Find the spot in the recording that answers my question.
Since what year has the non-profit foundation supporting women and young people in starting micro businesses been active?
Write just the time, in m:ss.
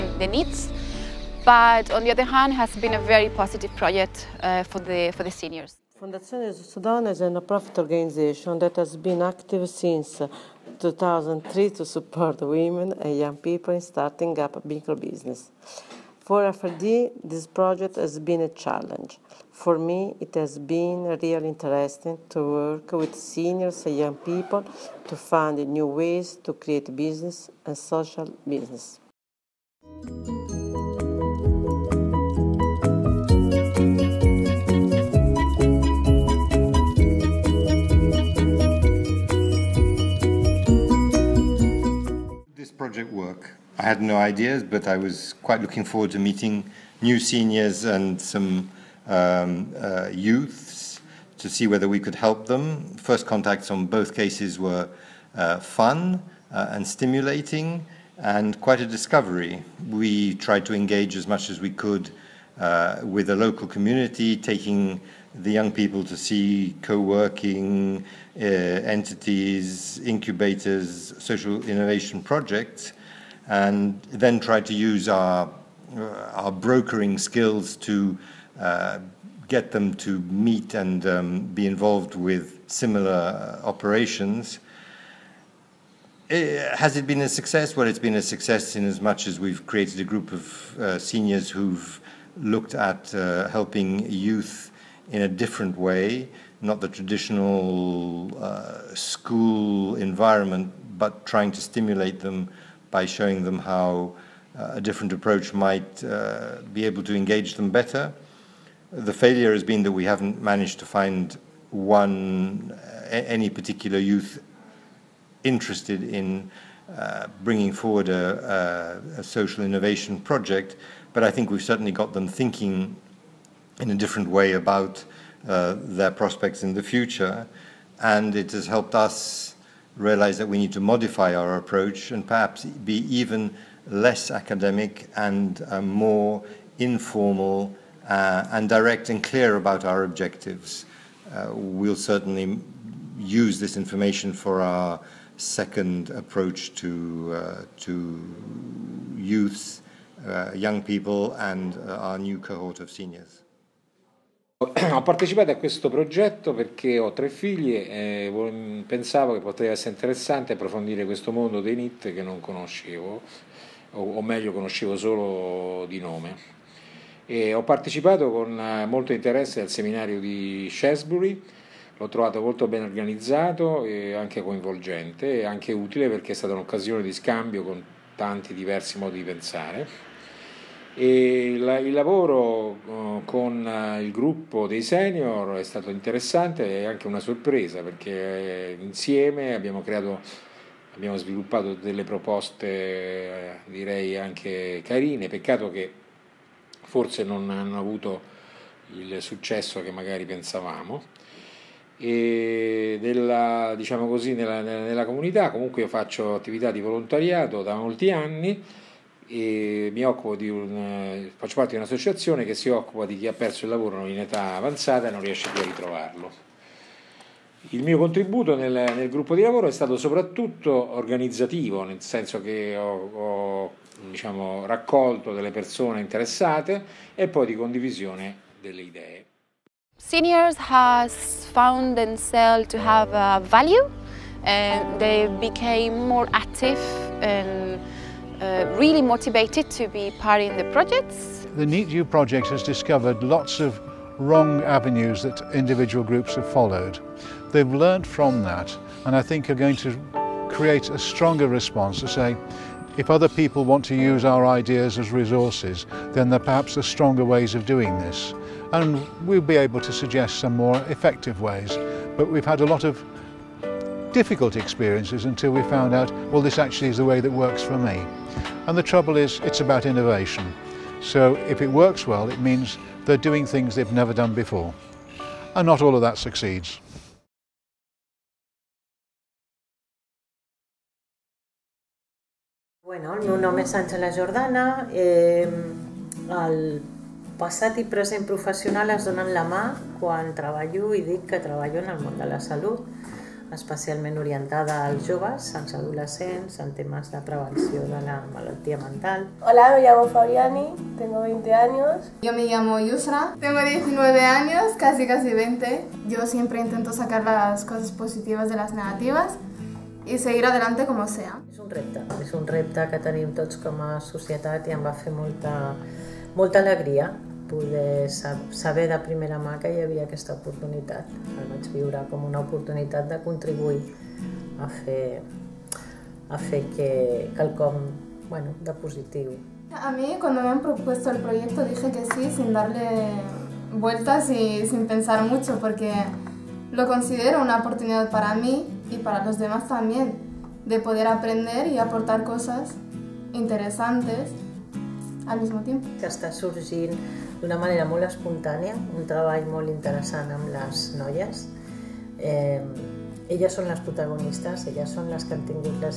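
0:10.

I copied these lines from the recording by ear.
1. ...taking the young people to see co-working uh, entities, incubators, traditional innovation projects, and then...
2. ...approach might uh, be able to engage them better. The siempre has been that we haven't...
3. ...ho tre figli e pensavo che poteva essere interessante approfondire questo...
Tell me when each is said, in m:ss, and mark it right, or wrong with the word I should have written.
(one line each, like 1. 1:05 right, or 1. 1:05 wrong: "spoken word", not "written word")
1. 1:04 wrong: "social", not "traditional"
2. 1:45 wrong: "failure", not "siempre"
3. 2:36 right.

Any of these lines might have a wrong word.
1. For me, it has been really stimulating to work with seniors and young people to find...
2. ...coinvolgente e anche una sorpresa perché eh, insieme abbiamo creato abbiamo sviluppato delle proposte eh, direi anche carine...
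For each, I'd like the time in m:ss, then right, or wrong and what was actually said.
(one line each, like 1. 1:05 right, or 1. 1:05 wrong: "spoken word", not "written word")
1. 0:19 wrong: "interesting", not "stimulating"
2. 3:05 wrong: "interessante", not "coinvolgente".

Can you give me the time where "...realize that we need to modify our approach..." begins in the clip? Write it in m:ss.
2:09.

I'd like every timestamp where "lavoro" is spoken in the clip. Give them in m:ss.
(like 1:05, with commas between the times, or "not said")
3:01, 3:33, 3:39.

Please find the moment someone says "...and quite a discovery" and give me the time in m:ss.
0:58.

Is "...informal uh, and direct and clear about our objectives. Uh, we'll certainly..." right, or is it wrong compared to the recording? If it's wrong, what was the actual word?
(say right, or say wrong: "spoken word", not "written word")
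right.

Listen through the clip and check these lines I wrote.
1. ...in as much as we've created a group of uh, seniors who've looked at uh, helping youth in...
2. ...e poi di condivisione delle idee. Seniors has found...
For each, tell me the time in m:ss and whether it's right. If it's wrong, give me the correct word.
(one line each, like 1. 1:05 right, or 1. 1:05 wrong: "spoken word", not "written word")
1. 1:28 right
2. 3:47 right.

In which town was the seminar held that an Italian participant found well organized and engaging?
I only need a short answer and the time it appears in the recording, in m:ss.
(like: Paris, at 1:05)
Shrewsbury, at 2:50.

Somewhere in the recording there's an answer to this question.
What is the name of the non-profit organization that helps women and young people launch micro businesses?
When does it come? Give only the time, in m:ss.
0:05.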